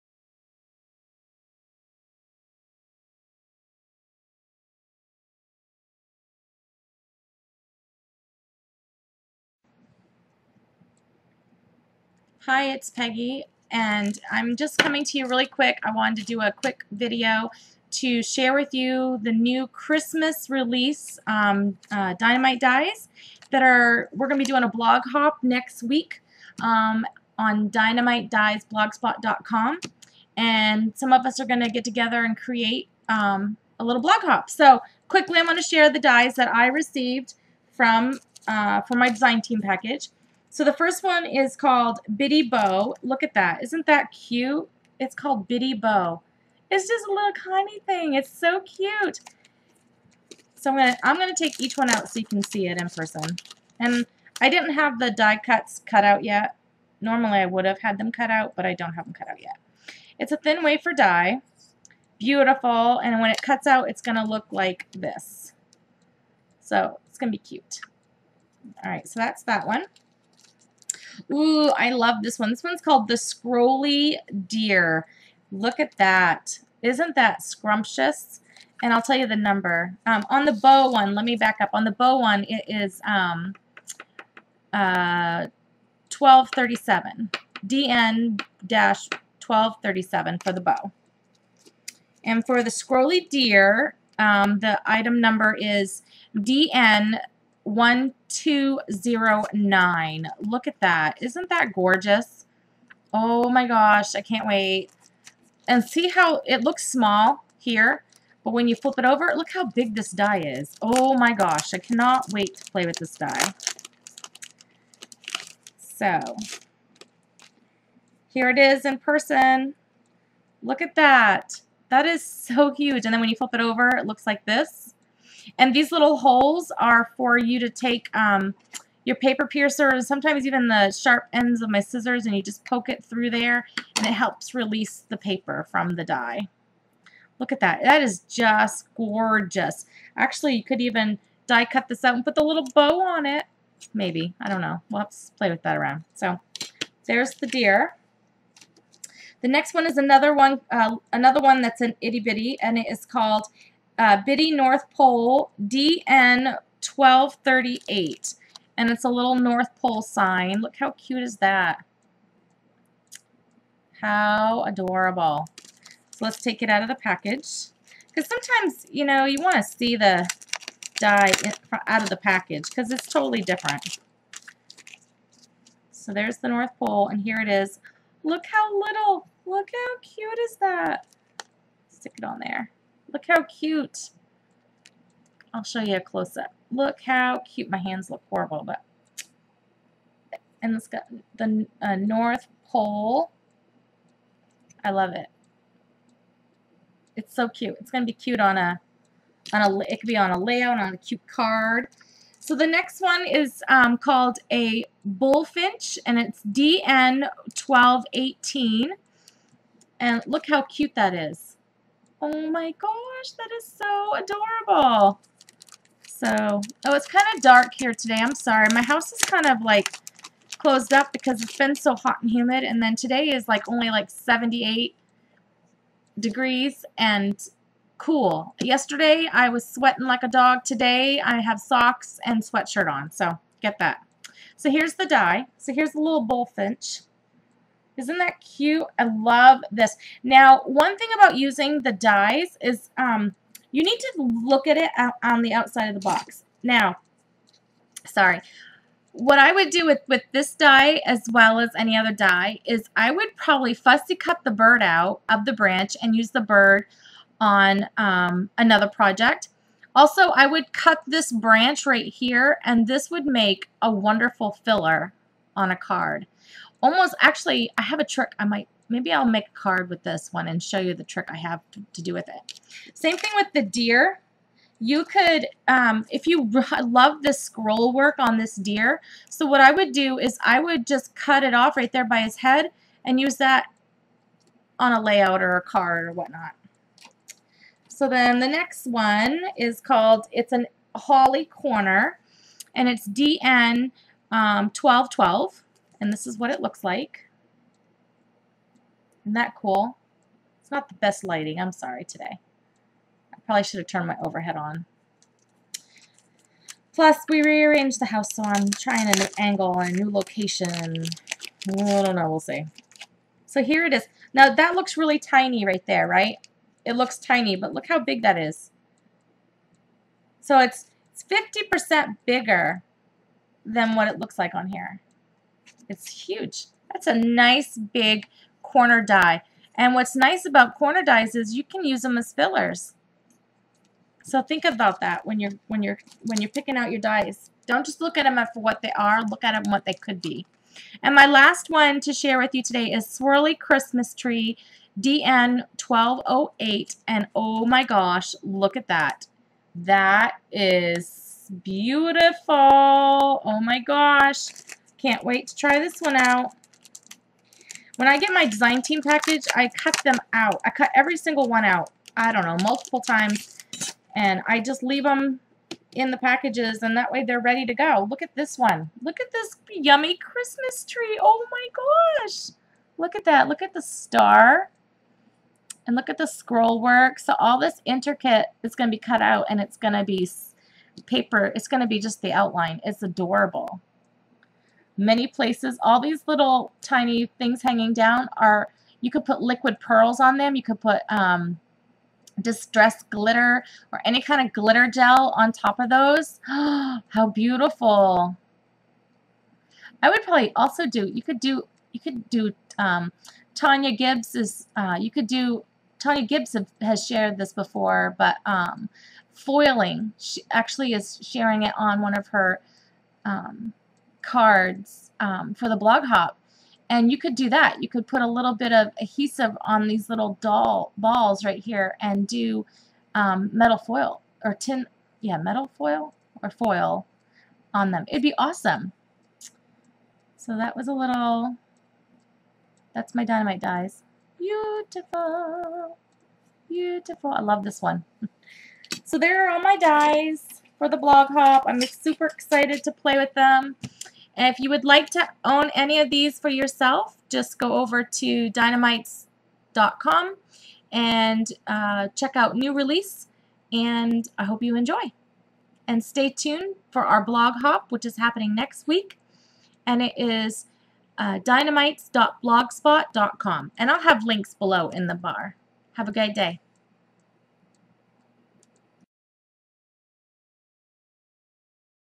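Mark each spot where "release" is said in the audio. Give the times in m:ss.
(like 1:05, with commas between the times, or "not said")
0:20, 2:14, 7:32.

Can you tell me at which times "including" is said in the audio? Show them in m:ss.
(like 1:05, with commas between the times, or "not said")
not said.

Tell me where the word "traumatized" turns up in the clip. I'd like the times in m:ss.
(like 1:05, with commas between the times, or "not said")
not said.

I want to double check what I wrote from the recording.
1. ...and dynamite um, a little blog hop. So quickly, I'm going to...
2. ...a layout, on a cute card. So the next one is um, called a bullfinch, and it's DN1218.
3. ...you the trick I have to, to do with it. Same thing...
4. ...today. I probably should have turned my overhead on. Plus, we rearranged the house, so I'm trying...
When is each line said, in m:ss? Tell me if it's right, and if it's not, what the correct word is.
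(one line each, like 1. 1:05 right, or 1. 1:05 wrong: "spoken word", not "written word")
1. 0:32 wrong: "create", not "dynamite"
2. 3:20 right
3. 4:30 right
4. 5:02 right.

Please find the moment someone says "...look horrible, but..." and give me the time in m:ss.
3:08.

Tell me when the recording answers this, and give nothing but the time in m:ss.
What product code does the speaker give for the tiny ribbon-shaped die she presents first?
1:27.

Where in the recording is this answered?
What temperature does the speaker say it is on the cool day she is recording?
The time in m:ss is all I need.
3:44.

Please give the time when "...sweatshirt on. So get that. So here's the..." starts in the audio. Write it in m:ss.
3:52.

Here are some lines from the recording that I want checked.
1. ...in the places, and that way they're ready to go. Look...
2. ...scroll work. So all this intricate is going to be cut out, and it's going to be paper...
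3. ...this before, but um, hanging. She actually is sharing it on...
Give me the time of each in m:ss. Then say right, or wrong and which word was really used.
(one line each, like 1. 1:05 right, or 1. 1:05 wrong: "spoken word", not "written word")
1. 6:05 wrong: "packages", not "places"
2. 6:16 right
3. 6:47 wrong: "foiling", not "hanging".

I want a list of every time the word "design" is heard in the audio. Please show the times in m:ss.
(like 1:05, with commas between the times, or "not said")
0:39, 5:58.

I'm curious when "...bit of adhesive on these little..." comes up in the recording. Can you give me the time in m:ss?
6:58.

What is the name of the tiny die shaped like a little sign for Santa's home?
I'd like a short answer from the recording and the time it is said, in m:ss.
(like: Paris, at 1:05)
Bitty North Pole, at 2:34.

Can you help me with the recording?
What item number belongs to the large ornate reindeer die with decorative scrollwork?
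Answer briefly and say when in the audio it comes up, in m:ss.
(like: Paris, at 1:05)
DN 1209, at 1:36.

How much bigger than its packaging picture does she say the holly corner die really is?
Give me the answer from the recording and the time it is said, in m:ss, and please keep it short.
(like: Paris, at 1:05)
50%, at 5:21.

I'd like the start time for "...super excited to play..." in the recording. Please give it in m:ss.
7:21.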